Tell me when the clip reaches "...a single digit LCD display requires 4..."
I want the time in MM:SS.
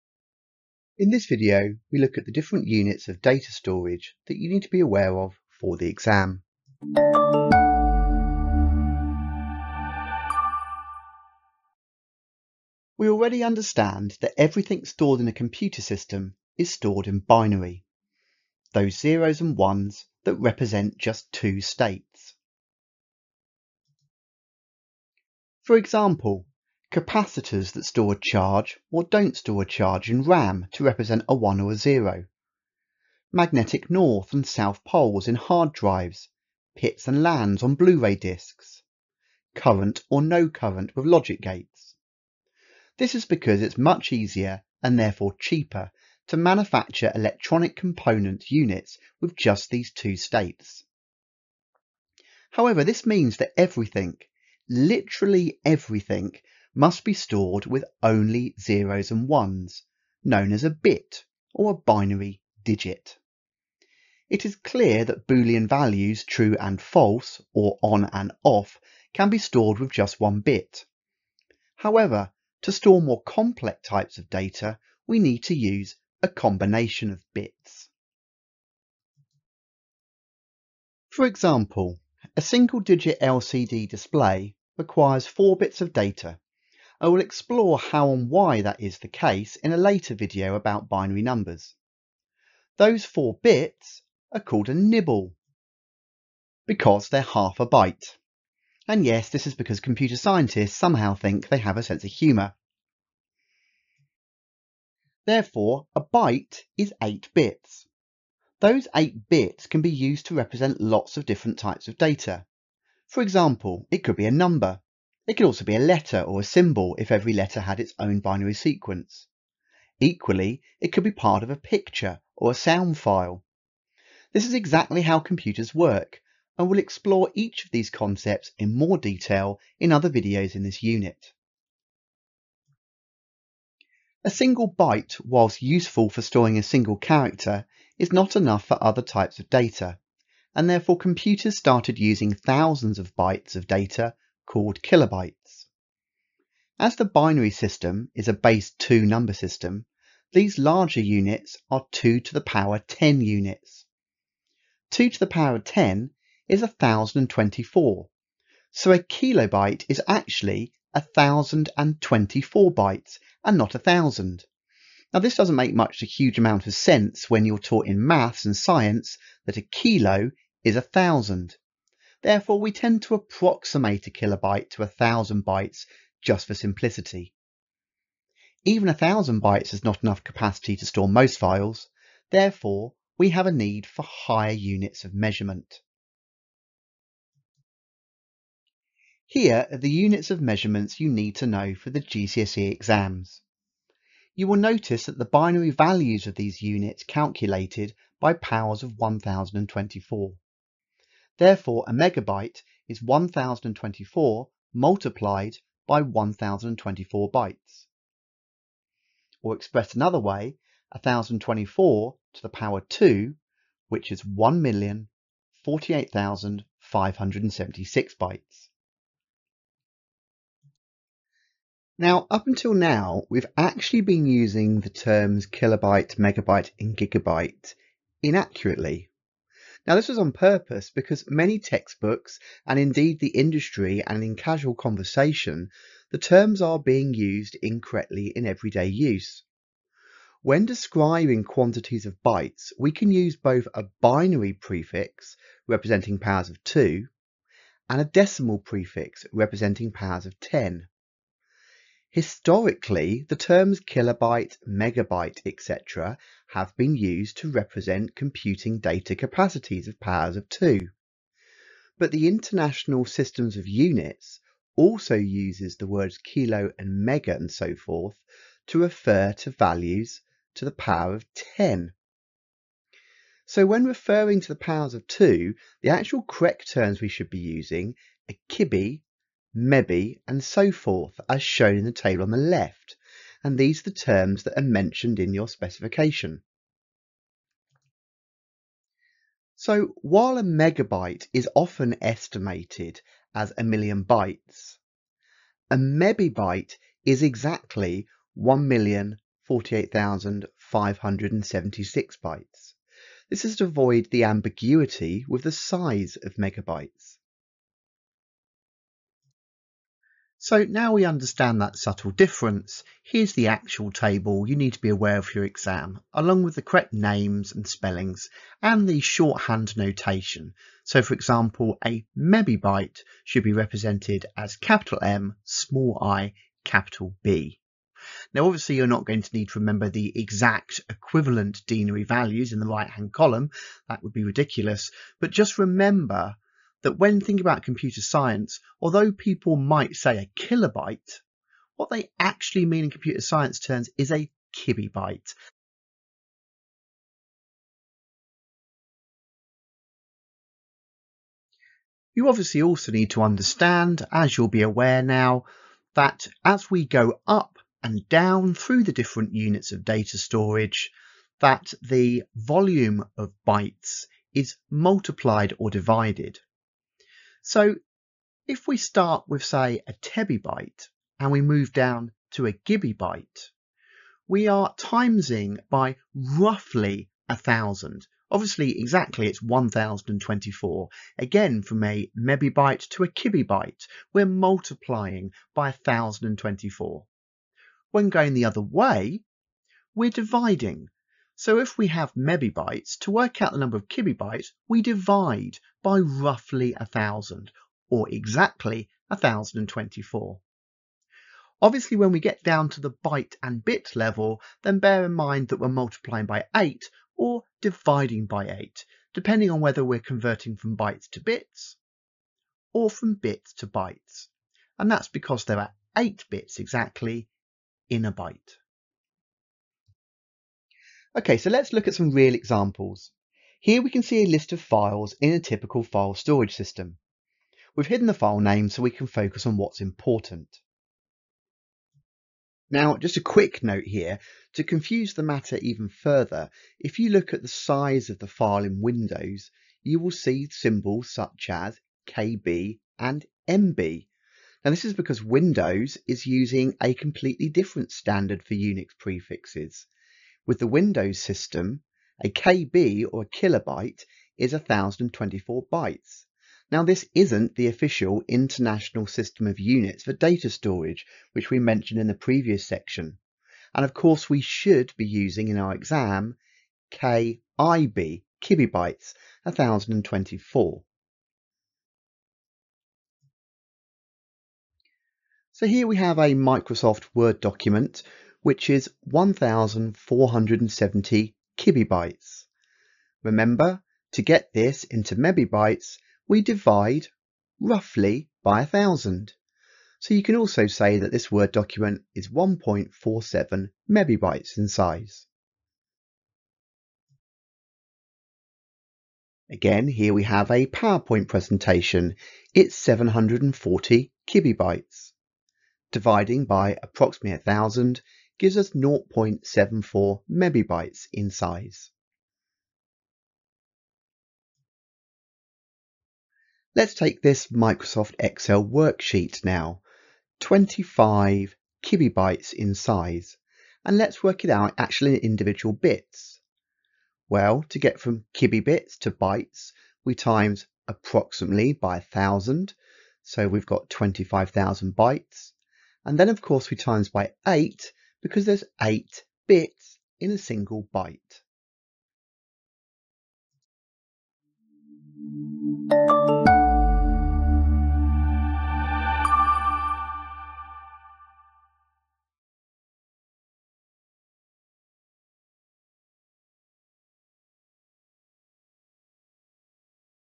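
01:22.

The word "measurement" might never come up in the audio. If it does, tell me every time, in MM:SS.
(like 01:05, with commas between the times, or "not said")
03:05, 03:10.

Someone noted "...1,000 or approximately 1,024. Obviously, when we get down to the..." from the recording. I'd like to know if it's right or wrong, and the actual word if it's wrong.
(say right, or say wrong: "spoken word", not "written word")
wrong: "exactly", not "approximately".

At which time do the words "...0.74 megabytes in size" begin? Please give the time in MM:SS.
08:28.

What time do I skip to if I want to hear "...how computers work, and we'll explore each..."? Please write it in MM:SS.
02:05.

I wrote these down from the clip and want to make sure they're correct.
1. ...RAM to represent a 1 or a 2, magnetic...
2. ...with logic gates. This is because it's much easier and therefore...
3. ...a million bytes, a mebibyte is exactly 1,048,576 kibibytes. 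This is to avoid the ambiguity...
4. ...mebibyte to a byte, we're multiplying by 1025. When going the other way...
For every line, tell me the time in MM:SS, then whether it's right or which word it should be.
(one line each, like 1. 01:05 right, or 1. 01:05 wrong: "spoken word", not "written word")
1. 00:30 wrong: "0", not "2"
2. 00:40 right
3. 04:53 wrong: "bytes", not "kibibytes"
4. 06:22 wrong: "1024", not "1025".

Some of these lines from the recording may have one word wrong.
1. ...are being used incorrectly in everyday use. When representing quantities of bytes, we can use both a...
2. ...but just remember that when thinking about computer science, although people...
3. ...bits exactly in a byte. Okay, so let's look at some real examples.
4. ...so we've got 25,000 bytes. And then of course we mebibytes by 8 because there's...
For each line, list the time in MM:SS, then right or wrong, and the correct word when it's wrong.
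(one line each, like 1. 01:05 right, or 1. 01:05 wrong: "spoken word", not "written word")
1. 03:56 wrong: "describing", not "representing"
2. 05:35 right
3. 06:56 right
4. 08:53 wrong: "times", not "mebibytes".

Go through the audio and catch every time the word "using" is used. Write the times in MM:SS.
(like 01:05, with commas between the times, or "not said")
02:21, 03:44, 04:37, 07:26, 07:45.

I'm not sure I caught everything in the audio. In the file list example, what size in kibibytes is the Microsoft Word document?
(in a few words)
1470.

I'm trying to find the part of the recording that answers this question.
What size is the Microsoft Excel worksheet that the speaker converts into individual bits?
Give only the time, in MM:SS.
08:40.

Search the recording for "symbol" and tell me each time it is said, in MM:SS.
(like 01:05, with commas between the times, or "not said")
01:56, 07:20.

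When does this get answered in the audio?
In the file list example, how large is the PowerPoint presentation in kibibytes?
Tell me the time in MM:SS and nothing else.
08:22.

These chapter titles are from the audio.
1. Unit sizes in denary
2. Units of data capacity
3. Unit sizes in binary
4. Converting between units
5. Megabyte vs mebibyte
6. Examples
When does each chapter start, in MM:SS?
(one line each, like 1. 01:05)
1. 03:08
2. 00:12
3. 05:09
4. 05:51
5. 03:41
6. 07:00.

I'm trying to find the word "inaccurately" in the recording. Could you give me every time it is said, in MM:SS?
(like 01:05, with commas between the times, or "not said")
03:48.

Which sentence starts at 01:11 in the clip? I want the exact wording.
However, to store more complex types of data, we need to use a combination of bits.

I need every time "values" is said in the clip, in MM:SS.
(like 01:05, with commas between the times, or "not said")
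01:05, 03:15, 04:29, 05:32.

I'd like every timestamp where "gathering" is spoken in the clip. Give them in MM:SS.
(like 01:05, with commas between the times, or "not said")
not said.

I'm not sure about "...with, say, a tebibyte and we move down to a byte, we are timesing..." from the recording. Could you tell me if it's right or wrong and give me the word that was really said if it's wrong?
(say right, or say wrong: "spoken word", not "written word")
right.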